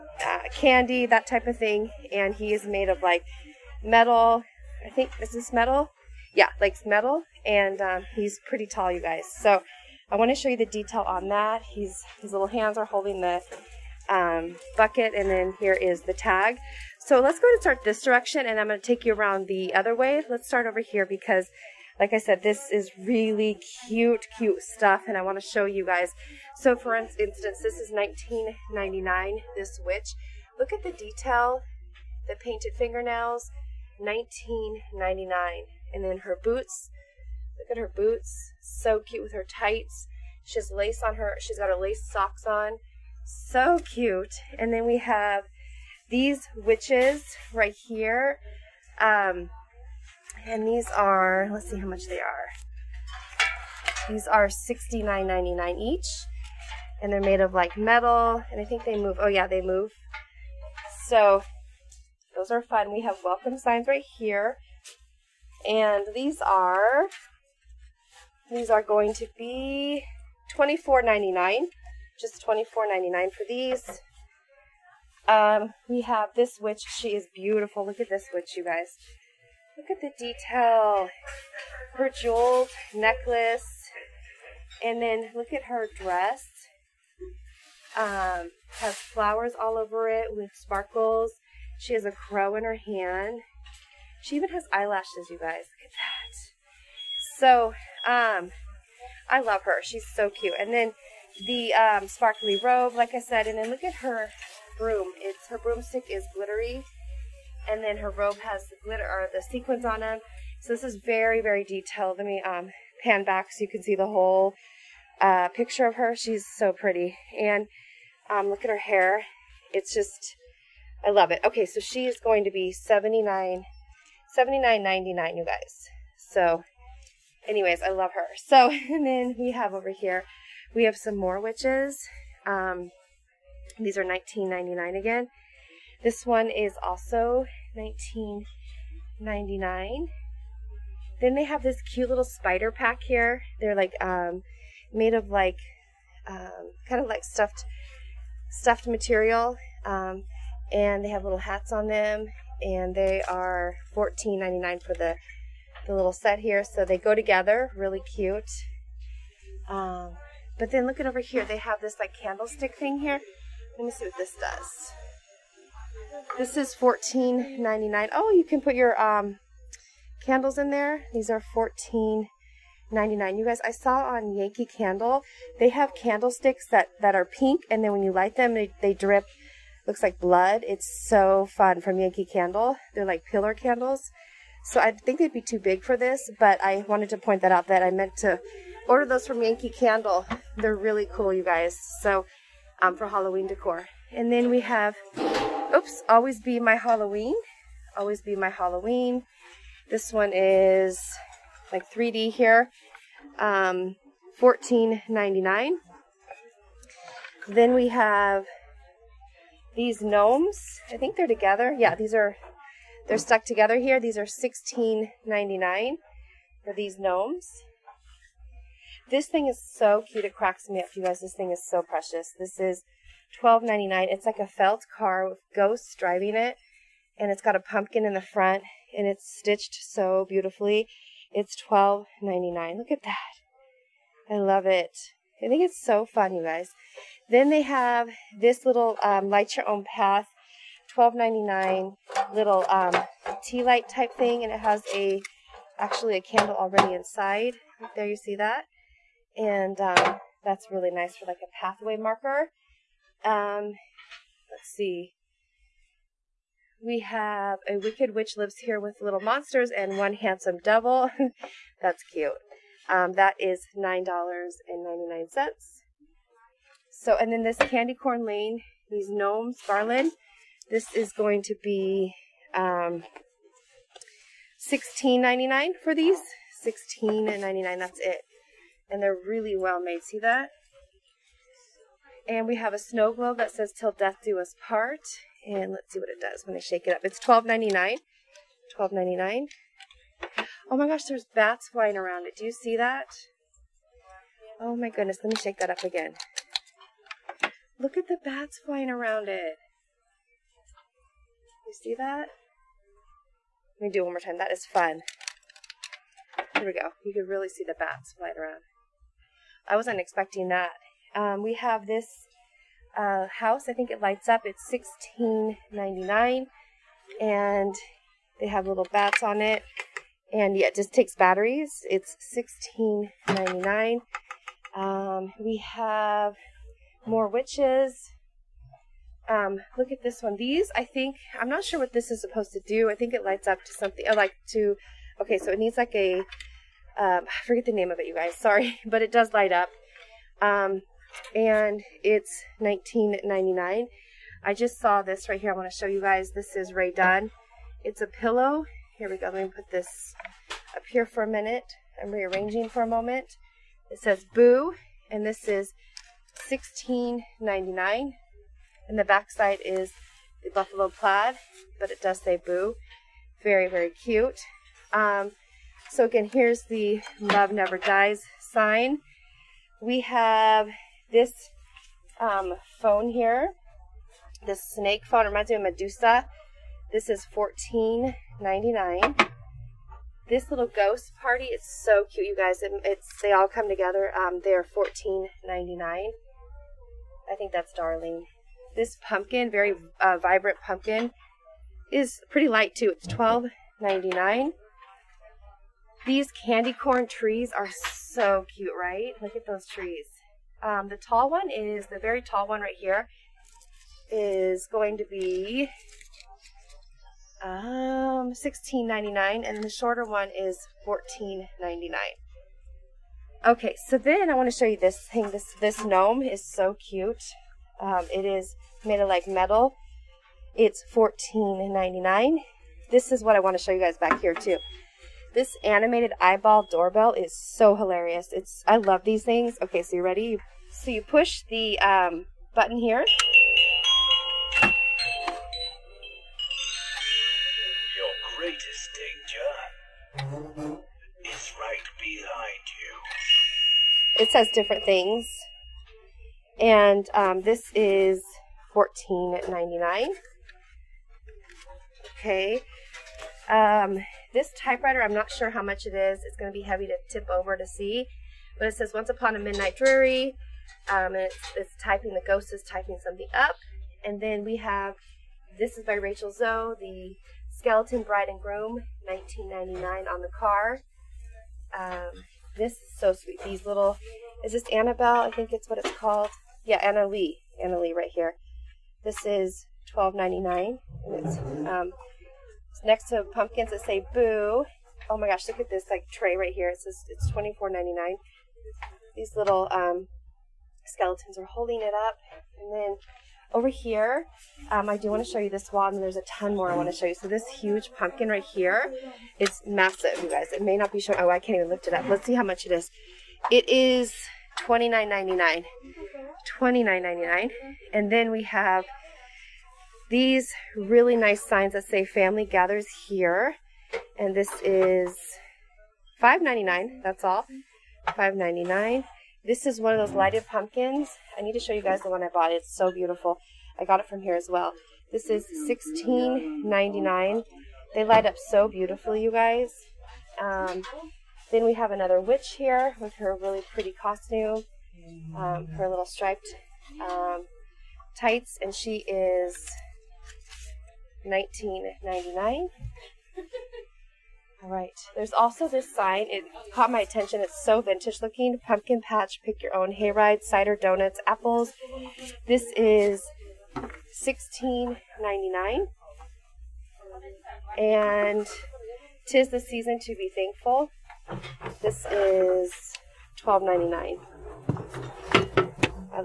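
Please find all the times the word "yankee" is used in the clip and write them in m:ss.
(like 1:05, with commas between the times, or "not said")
2:54, 3:01, 3:09.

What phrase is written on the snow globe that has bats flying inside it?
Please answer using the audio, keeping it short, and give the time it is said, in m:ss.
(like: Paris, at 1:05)
Till Death Do Us Part, at 4:43.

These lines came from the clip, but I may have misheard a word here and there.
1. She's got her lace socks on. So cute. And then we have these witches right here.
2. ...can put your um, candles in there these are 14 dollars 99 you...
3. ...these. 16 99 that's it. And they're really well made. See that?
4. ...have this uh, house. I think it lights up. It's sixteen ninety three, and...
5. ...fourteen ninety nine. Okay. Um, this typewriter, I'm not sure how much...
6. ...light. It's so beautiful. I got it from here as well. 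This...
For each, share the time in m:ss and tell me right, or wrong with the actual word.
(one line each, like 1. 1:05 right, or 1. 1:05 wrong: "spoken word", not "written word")
1. 0:41 right
2. 2:48 right
3. 4:35 right
4. 5:11 wrong: "nine", not "three"
5. 7:28 right
6. 8:42 wrong: "bought", not "light".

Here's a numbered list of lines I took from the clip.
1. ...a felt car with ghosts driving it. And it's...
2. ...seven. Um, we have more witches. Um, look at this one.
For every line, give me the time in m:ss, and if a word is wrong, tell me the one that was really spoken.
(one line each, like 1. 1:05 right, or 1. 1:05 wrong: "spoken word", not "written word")
1. 3:44 right
2. 5:23 wrong: "nine", not "seven".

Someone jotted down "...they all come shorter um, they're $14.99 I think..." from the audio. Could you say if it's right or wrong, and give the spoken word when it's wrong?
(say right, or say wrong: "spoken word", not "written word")
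wrong: "together", not "shorter".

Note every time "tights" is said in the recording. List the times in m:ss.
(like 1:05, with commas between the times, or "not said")
0:39, 8:58.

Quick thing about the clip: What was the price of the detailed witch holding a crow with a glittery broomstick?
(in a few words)
$79.99.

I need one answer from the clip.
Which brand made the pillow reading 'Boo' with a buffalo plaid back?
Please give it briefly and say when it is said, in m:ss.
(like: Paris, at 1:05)
Rae Dunn, at 5:46.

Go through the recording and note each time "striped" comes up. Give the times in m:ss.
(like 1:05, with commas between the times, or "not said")
8:56.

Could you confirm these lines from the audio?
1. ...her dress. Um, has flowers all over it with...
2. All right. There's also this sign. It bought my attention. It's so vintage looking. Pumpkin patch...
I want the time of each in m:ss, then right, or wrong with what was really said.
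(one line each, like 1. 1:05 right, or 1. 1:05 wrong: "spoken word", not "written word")
1. 1:25 right
2. 9:04 wrong: "caught", not "bought".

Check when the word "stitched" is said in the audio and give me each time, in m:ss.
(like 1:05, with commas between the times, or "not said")
3:49.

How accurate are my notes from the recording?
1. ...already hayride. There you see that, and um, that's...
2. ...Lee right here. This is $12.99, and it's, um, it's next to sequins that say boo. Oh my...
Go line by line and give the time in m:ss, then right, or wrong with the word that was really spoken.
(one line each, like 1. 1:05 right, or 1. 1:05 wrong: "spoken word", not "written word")
1. 4:06 wrong: "inside", not "hayride"
2. 7:57 wrong: "pumpkins", not "sequins".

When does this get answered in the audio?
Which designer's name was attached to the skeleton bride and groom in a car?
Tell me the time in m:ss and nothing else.
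7:45.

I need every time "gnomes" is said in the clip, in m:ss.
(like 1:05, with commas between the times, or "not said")
3:30, 3:36, 4:29, 6:55.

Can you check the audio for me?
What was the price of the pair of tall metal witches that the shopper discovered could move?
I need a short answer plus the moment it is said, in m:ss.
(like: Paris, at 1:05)
$69.99, at 0:54.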